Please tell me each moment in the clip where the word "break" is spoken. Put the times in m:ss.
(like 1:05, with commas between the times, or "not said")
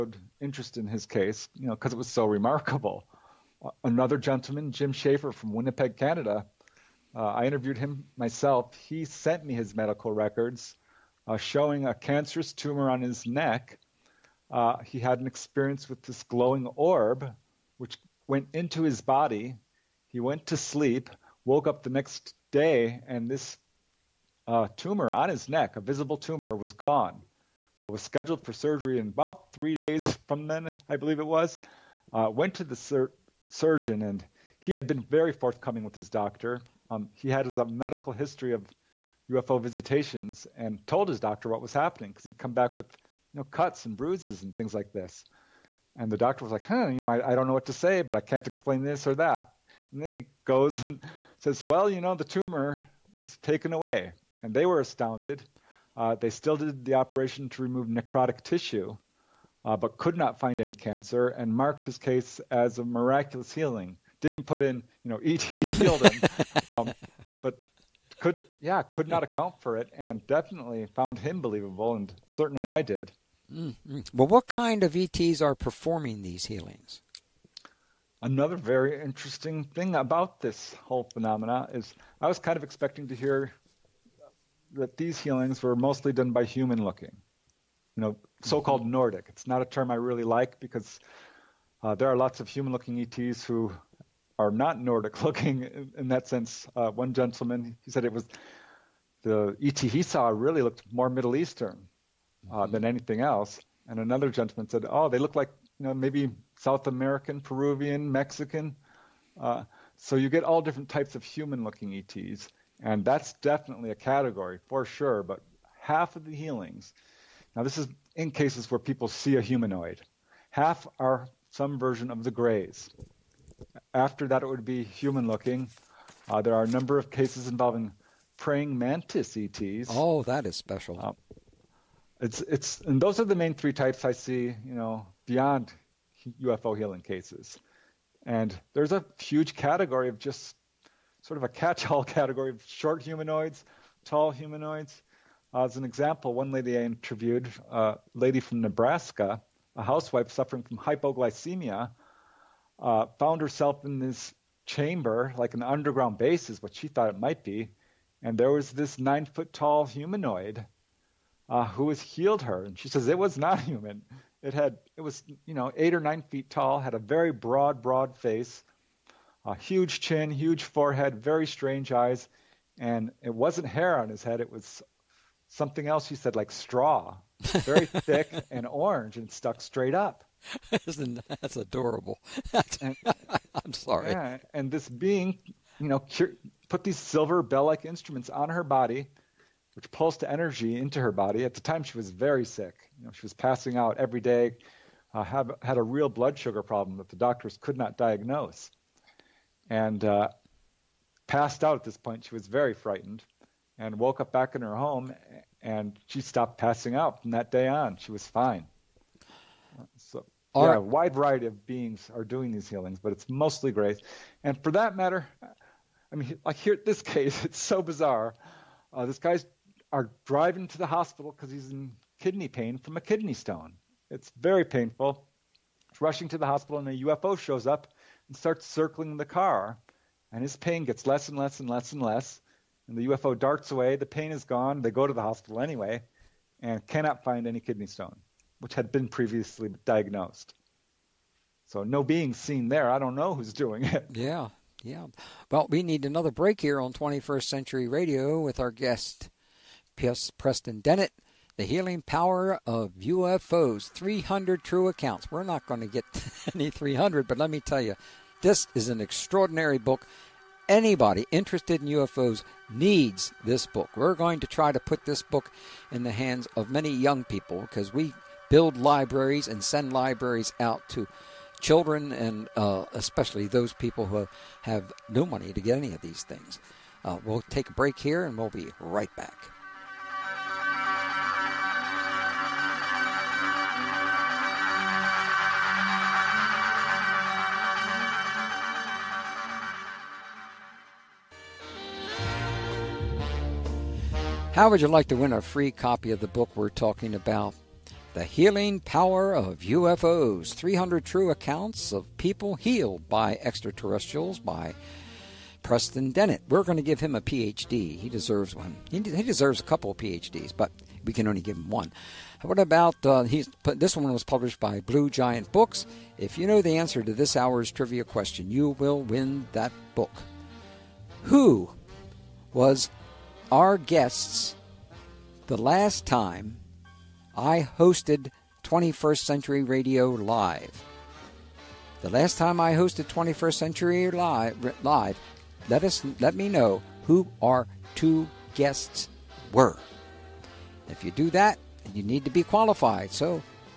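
4:06, 4:37.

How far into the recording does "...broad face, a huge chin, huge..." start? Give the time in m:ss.
2:47.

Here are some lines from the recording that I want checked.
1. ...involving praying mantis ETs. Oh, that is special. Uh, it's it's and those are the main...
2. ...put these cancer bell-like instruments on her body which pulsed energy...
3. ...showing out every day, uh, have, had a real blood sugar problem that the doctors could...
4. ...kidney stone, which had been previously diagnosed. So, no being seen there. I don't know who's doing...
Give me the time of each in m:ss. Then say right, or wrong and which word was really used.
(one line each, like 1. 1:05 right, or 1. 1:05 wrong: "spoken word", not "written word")
1. 2:07 right
2. 3:06 wrong: "silver", not "cancer"
3. 3:13 wrong: "passing", not "showing"
4. 3:57 right.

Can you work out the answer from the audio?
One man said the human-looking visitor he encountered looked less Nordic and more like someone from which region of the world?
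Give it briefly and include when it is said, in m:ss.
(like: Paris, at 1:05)
Middle Eastern, at 1:41.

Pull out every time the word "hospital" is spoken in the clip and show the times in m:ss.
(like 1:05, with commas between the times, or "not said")
3:40, 3:46, 3:55.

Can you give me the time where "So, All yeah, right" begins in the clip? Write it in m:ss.
3:29.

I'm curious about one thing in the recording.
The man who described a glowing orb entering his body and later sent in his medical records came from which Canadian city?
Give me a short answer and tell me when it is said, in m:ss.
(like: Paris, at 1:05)
Winnipeg, at 0:05.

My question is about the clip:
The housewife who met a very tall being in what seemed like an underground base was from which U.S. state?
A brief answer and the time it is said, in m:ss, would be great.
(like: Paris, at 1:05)
Nebraska, at 2:28.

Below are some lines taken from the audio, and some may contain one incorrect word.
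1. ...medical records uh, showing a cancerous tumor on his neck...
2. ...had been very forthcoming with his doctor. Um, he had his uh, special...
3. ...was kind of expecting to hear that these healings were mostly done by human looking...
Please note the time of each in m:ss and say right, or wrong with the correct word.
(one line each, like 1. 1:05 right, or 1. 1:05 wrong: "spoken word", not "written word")
1. 0:09 right
2. 0:34 wrong: "medical", not "special"
3. 1:22 right.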